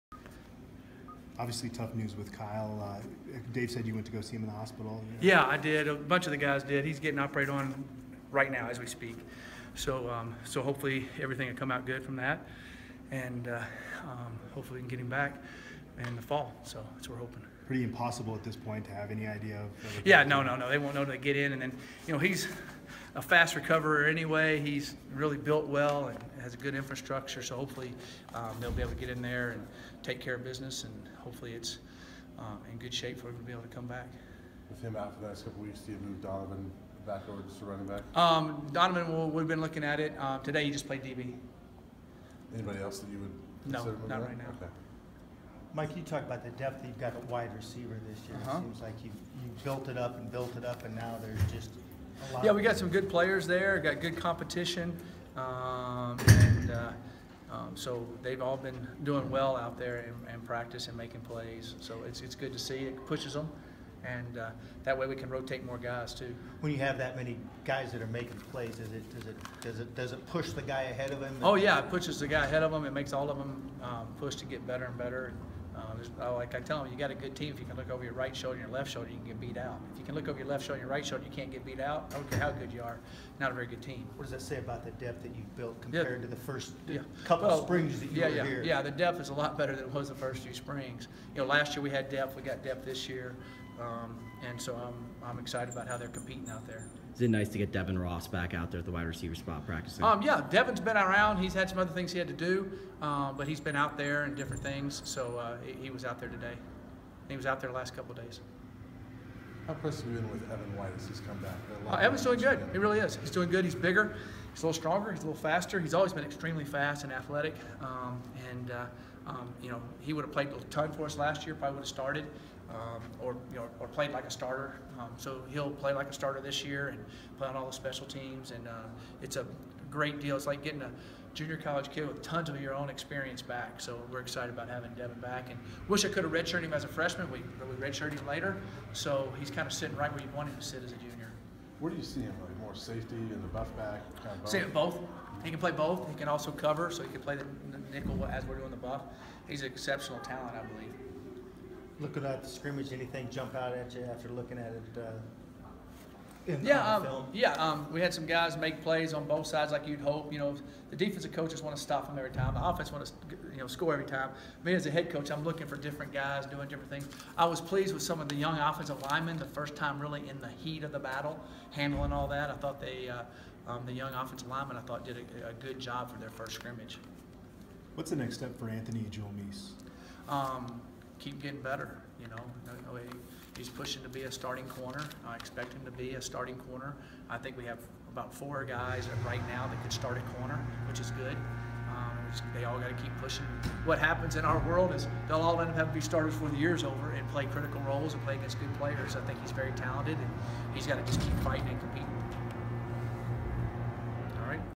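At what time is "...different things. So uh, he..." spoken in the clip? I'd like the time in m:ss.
1:44.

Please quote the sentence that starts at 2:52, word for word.
I thought they, uh, um, the young offensive linemen, I thought did a, a, good job for their first scrimmage.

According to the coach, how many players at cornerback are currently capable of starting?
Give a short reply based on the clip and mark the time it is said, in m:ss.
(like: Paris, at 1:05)
4, at 3:08.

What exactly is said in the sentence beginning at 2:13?
So we're excited about having Devin back, and wish I could have redshirted him as a freshman.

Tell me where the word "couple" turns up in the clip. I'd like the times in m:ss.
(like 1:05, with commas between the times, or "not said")
0:35, 1:27, 1:47.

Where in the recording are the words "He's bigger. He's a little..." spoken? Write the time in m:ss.
1:53.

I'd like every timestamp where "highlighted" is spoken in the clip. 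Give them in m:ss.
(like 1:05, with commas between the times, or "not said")
not said.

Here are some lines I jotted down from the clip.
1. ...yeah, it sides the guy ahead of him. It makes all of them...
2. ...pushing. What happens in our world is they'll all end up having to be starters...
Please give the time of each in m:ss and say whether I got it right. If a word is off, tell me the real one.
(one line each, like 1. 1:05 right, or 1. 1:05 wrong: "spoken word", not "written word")
1. 1:11 wrong: "pushes", not "sides"
2. 3:13 right.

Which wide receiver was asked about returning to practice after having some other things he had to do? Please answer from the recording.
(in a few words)
Devin Ross.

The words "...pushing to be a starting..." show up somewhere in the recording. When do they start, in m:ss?
3:03.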